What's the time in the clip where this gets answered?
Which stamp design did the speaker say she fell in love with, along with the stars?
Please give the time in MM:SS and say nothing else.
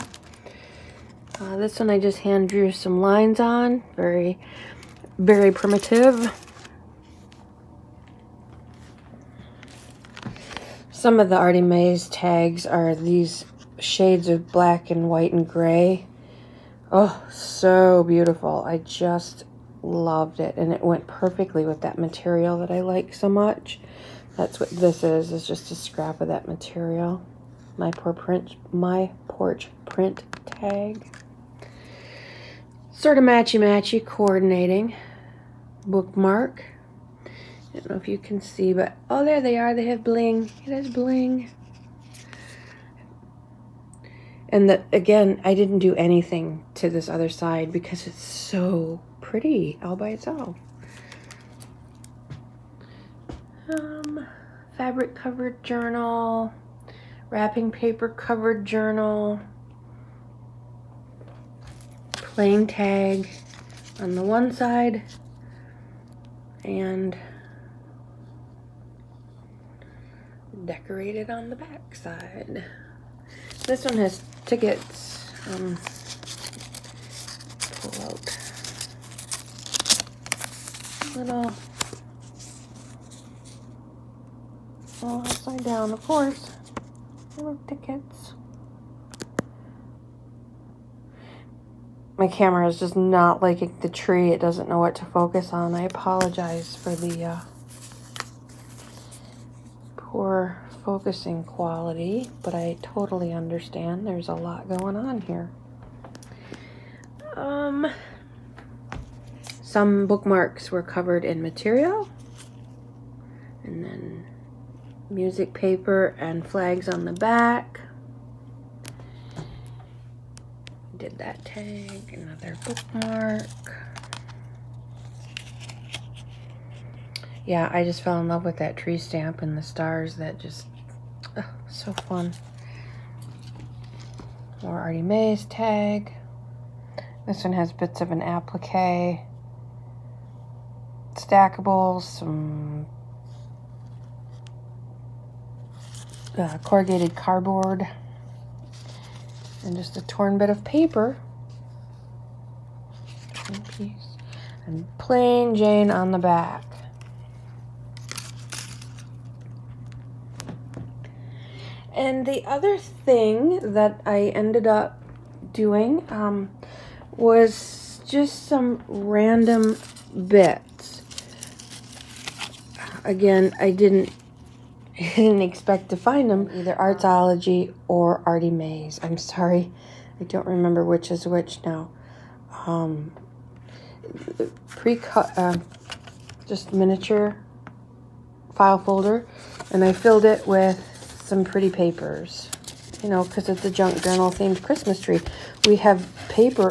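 02:08.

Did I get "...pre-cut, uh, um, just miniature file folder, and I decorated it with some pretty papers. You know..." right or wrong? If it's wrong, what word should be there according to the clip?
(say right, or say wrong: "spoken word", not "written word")
wrong: "filled", not "decorated".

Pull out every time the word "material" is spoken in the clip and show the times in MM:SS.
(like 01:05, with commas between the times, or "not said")
00:21, 00:26, 01:51.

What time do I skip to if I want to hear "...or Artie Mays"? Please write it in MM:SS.
02:57.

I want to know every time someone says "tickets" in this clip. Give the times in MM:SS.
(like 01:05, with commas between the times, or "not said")
01:14, 01:27.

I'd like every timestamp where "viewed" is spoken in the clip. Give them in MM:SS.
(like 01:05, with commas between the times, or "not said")
not said.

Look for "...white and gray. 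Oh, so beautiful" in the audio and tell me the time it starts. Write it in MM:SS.
00:15.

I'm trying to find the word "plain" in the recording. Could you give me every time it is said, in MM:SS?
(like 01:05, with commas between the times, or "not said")
01:02, 02:34.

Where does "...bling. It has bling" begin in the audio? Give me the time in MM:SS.
00:40.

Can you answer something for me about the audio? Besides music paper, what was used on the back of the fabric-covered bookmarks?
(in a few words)
Flags.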